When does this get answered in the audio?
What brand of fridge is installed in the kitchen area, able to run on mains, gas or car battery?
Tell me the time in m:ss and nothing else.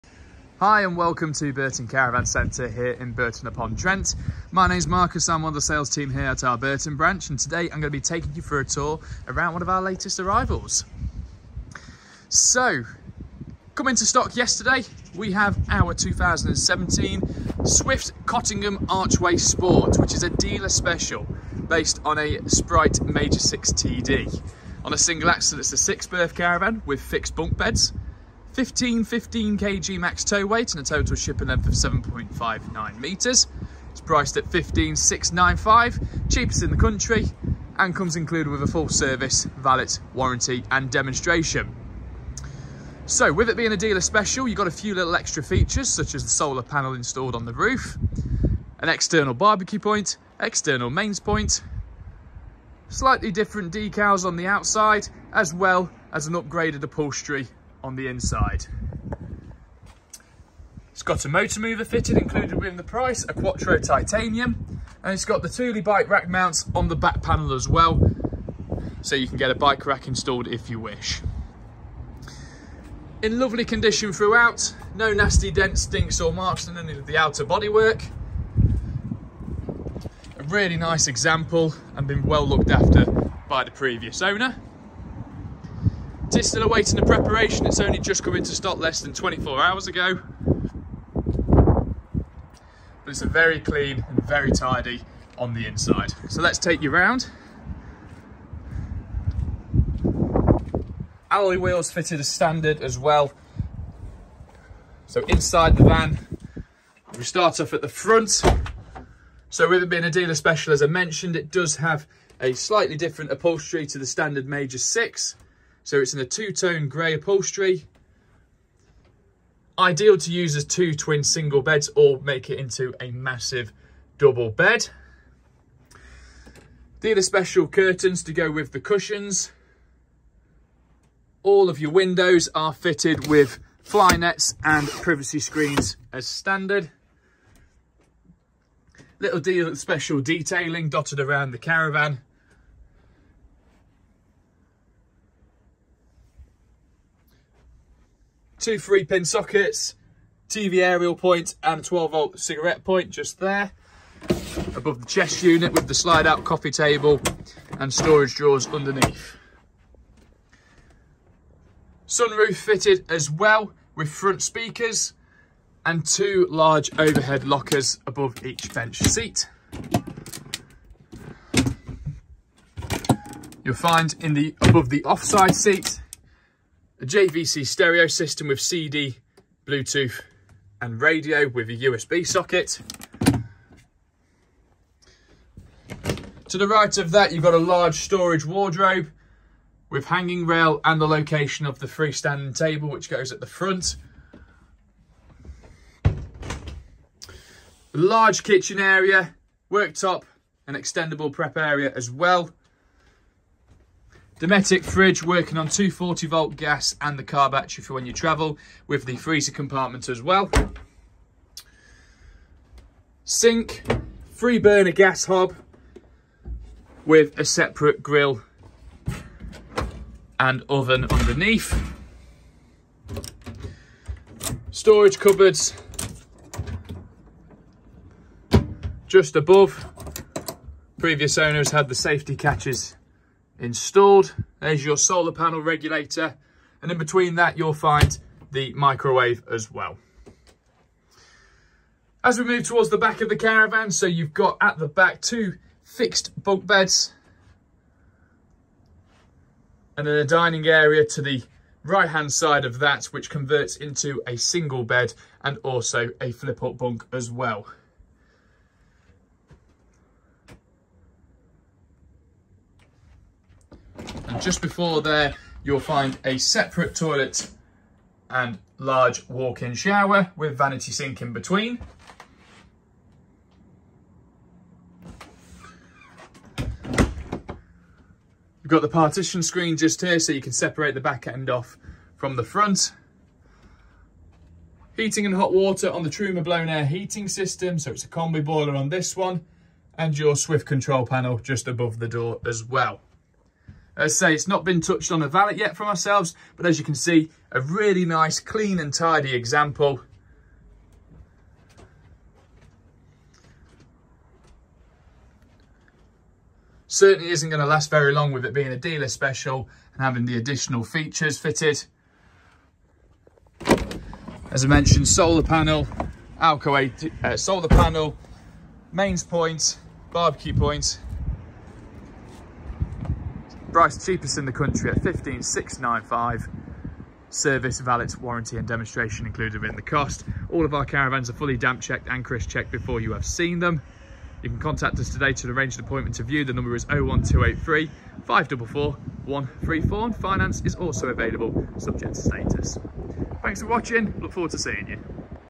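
3:24.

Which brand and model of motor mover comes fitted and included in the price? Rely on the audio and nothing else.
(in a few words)
Quattro titanium.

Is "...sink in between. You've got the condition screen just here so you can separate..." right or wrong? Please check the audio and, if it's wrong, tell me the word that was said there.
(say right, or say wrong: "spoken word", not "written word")
wrong: "partition", not "condition".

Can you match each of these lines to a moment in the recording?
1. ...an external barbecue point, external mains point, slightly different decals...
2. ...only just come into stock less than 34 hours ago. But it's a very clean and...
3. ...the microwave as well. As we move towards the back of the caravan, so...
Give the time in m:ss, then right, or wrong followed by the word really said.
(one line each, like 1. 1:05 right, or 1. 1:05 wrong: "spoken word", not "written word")
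1. 0:48 right
2. 1:27 wrong: "24", not "34"
3. 3:58 right.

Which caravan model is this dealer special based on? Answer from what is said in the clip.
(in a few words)
Sprite Major 6 TD.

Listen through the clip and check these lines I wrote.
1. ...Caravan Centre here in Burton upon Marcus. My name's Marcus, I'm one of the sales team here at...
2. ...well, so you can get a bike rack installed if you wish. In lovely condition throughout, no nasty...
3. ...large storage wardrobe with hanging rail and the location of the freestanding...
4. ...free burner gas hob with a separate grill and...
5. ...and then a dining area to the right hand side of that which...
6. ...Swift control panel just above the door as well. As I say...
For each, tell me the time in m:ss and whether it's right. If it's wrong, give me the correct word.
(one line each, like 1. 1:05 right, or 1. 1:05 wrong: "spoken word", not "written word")
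1. 0:01 wrong: "Trent", not "Marcus"
2. 1:07 right
3. 3:07 right
4. 3:34 right
5. 4:09 right
6. 4:50 right.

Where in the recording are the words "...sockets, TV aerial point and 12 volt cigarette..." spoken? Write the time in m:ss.
2:29.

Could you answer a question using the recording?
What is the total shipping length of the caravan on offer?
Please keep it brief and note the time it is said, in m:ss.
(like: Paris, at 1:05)
7.59 metres, at 0:31.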